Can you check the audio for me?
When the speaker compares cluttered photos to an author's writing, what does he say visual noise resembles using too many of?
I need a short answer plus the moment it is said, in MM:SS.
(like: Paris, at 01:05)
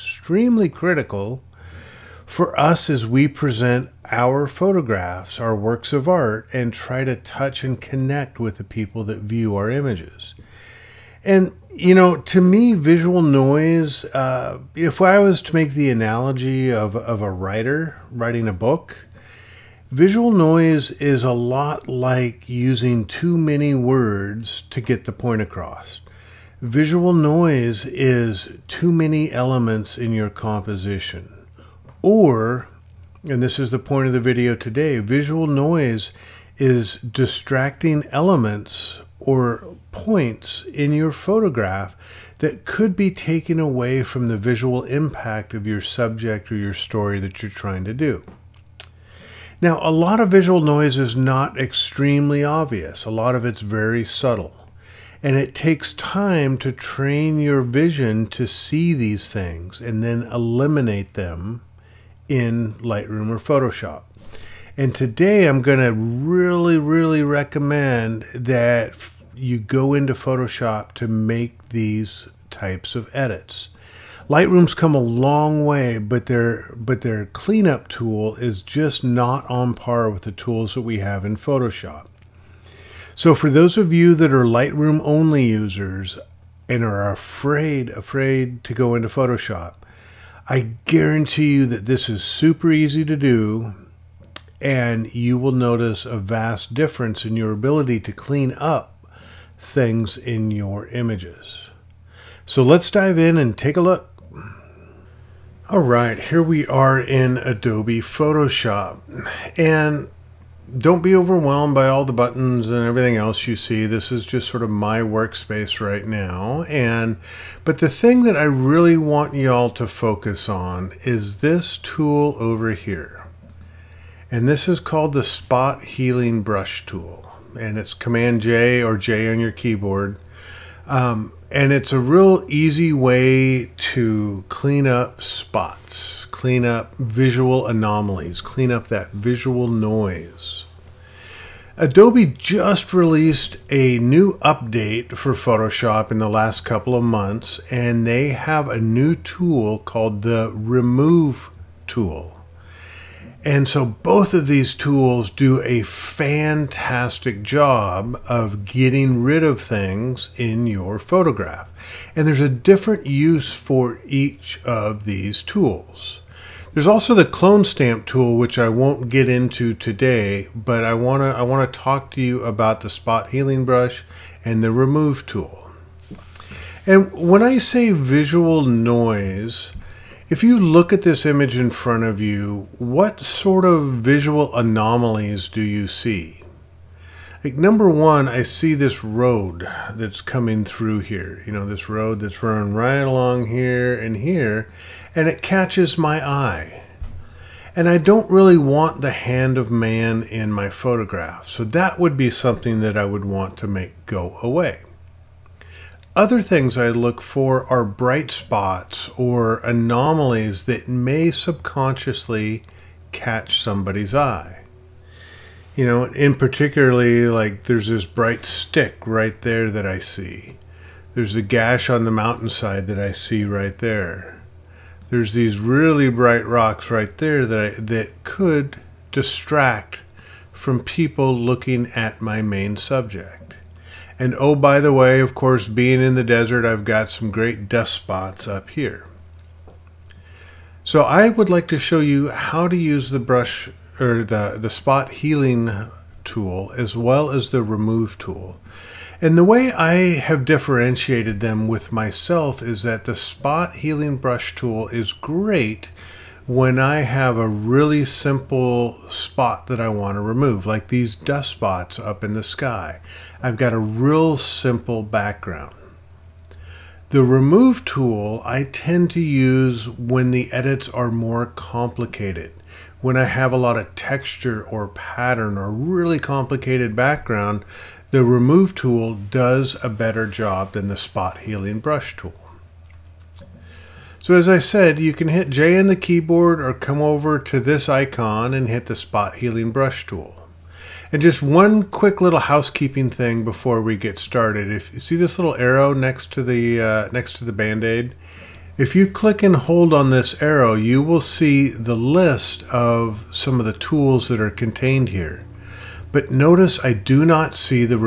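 Words, at 00:23.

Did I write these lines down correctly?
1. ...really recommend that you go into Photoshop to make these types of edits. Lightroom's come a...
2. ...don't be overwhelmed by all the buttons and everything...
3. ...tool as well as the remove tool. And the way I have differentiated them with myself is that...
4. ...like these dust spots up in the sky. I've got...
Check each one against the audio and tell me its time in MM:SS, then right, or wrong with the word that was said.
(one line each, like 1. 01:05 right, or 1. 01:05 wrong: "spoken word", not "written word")
1. 01:06 right
2. 01:50 right
3. 04:06 right
4. 04:20 right.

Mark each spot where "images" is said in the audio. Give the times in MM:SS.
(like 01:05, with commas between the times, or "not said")
00:09, 01:40, 03:01.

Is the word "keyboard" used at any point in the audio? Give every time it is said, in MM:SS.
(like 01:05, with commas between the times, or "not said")
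02:09, 04:45.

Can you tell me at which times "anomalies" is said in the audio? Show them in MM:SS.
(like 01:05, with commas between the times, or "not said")
02:17, 03:04, 03:29.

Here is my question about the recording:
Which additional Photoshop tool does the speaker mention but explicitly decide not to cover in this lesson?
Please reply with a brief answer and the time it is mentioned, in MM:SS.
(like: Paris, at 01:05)
Clone stamp tool, at 02:47.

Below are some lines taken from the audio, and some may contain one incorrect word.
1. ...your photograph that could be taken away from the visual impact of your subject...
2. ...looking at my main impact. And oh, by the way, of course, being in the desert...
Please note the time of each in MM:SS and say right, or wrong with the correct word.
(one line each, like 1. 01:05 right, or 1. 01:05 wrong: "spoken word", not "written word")
1. 00:40 right
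2. 03:51 wrong: "subject", not "impact".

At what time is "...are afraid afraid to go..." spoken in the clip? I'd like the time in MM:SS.
01:26.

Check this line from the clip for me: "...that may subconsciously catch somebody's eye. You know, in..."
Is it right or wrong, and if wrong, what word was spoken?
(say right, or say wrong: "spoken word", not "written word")
right.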